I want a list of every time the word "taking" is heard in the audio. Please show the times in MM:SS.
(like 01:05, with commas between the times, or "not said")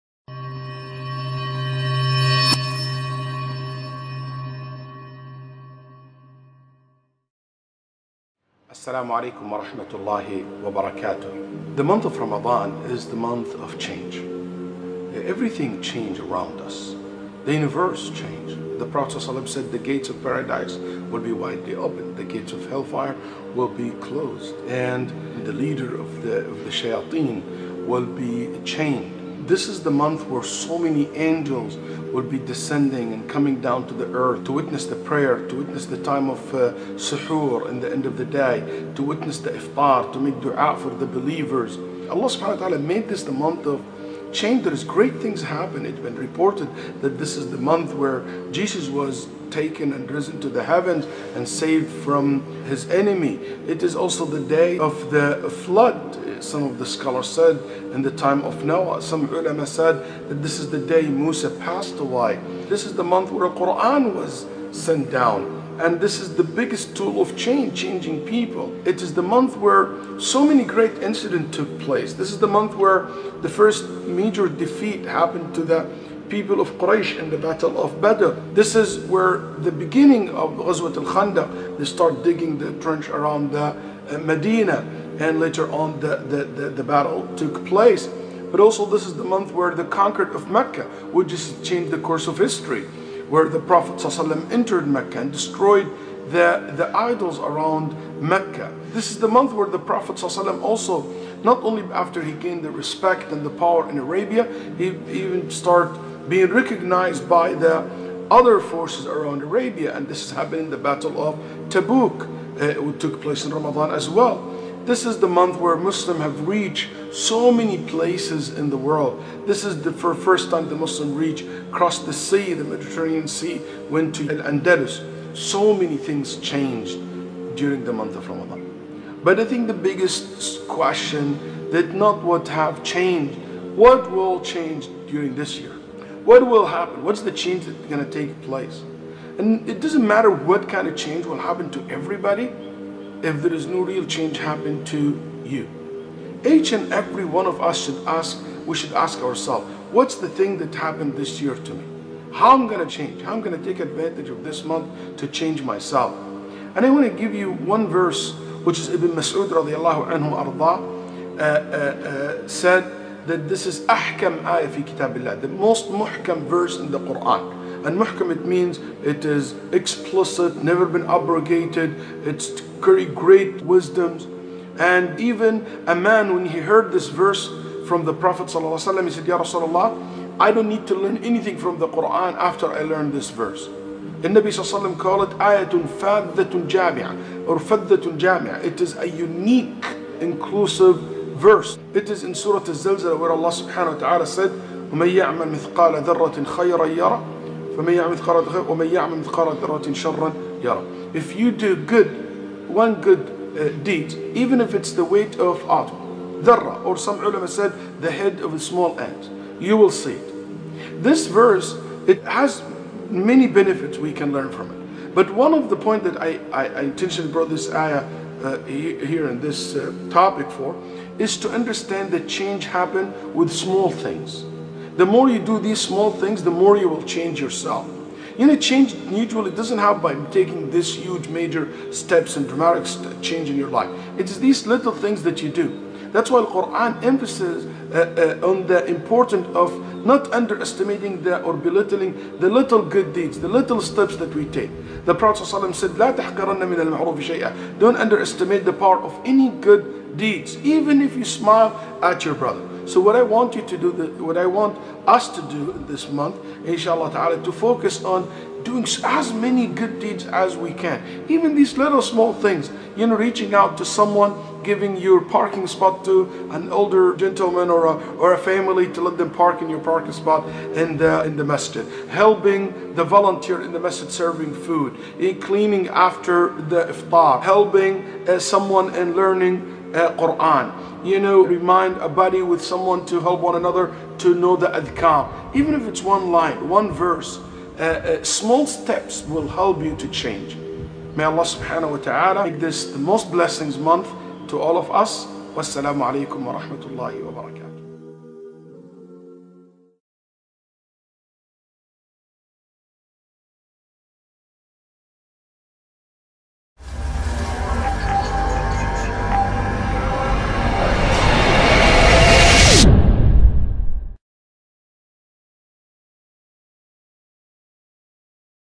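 03:50.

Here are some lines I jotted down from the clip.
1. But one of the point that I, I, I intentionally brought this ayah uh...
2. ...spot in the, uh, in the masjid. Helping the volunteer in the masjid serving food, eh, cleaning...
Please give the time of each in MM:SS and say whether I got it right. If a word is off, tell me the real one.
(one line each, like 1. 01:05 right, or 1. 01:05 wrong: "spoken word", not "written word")
1. 03:35 right
2. 04:30 right.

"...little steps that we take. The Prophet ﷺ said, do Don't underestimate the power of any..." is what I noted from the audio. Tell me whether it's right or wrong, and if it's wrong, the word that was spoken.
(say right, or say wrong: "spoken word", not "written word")
right.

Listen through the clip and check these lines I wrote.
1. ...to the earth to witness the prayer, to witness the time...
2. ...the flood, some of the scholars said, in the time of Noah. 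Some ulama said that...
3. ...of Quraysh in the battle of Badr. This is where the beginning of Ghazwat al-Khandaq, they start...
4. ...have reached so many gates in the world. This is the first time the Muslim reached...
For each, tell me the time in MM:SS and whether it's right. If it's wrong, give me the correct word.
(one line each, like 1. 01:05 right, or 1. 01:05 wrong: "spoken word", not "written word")
1. 00:33 right
2. 00:55 right
3. 01:16 right
4. 01:56 wrong: "places", not "gates".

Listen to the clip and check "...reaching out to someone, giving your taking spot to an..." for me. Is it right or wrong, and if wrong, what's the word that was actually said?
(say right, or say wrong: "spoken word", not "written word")
wrong: "parking", not "taking".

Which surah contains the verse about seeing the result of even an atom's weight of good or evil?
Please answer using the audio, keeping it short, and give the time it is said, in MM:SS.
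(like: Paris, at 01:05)
Surah Al-Zalzala, at 03:12.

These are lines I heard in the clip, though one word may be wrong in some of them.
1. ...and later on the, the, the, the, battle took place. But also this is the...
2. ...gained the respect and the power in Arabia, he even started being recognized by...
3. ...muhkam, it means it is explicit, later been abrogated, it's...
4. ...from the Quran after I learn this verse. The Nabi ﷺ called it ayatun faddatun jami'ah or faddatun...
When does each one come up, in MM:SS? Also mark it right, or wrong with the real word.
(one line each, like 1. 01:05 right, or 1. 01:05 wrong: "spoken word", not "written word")
1. 01:25 right
2. 01:42 right
3. 02:47 wrong: "never", not "later"
4. 03:01 right.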